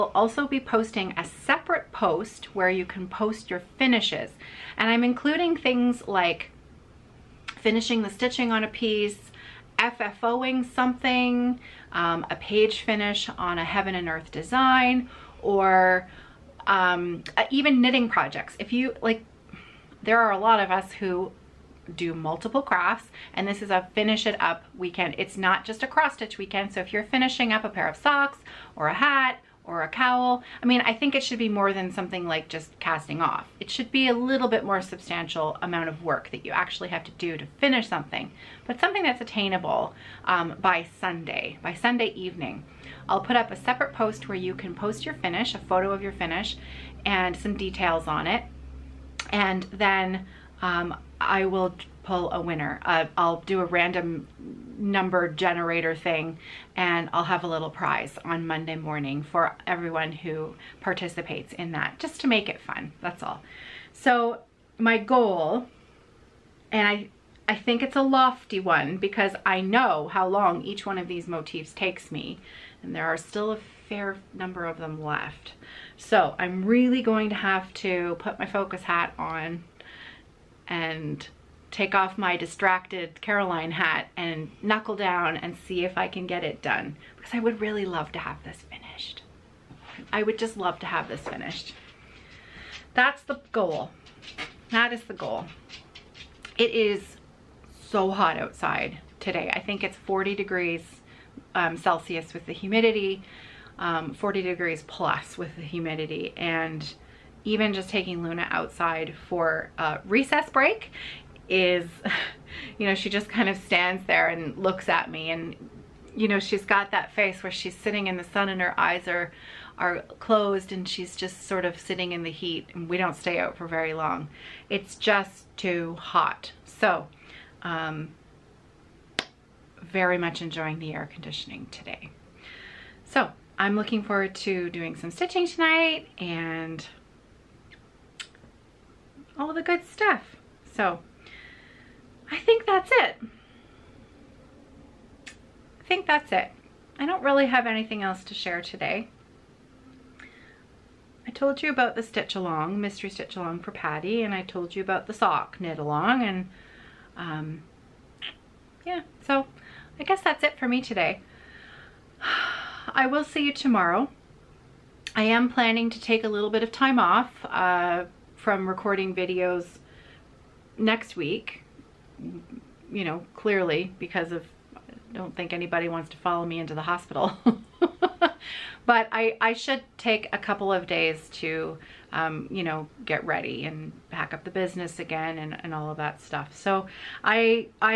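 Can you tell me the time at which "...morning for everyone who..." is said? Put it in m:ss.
0:58.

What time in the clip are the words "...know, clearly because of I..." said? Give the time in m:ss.
2:53.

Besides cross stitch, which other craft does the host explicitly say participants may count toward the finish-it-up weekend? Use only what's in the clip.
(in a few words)
knitting.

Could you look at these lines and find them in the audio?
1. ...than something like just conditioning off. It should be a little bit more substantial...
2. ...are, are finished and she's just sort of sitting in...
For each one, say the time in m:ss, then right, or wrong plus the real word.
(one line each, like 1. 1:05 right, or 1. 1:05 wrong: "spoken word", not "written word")
1. 0:31 wrong: "casting", not "conditioning"
2. 1:59 wrong: "closed", not "finished".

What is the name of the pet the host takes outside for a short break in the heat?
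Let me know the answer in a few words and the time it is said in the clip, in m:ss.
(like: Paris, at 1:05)
Luna, at 1:48.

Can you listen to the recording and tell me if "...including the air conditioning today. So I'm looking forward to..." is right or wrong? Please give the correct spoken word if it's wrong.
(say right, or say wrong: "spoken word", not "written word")
wrong: "enjoying", not "including".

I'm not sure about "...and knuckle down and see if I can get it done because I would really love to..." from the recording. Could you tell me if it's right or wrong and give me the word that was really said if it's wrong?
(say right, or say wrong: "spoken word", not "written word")
right.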